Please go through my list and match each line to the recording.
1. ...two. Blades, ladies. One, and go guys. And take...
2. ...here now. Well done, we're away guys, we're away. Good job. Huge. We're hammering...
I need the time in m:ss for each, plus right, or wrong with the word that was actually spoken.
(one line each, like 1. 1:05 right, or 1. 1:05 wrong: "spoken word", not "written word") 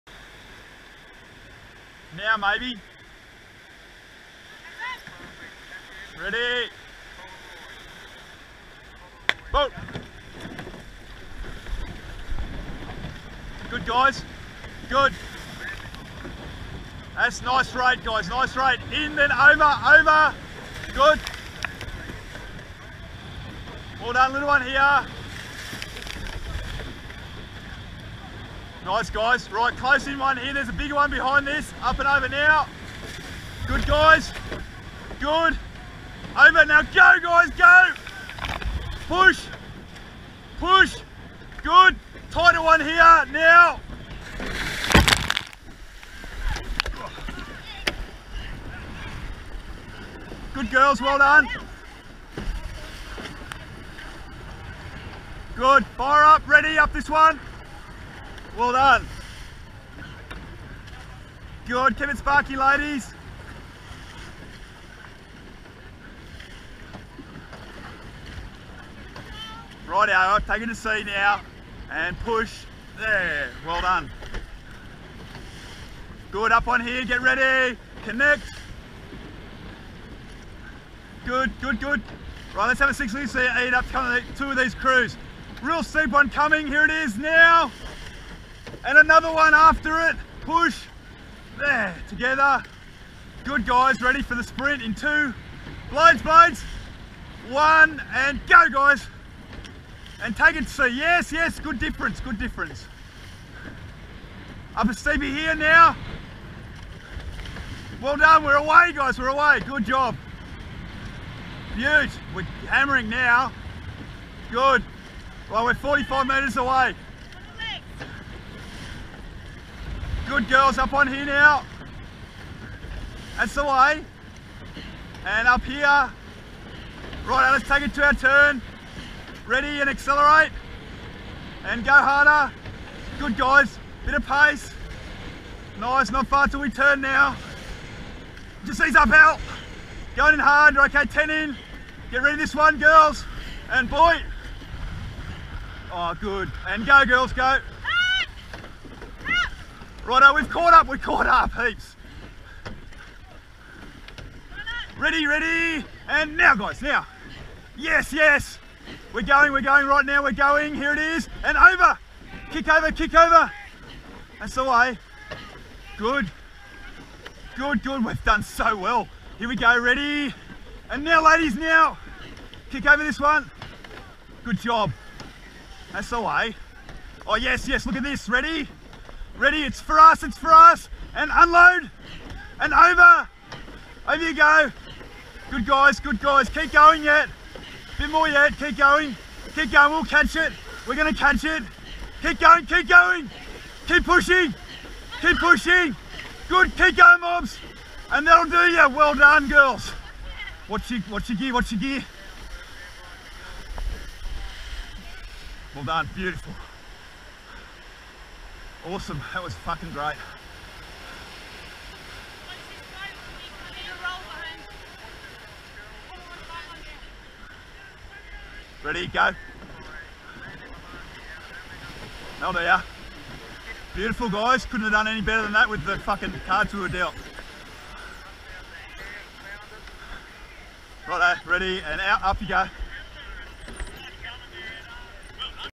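1. 1:34 wrong: "blades", not "ladies"
2. 1:45 right.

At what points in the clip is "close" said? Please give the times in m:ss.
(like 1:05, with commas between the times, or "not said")
0:29.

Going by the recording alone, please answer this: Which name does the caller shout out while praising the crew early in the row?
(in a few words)
Kevin Sparky.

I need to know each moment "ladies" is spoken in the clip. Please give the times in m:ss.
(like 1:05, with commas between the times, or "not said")
1:02, 2:51.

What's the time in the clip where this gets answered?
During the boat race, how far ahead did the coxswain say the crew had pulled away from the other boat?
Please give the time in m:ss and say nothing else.
1:55.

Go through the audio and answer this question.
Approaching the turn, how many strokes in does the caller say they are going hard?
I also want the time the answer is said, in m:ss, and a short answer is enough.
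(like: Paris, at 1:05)
10, at 2:21.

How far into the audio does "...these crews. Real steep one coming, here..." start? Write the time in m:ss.
1:24.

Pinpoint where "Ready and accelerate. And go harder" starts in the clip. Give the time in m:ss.
2:09.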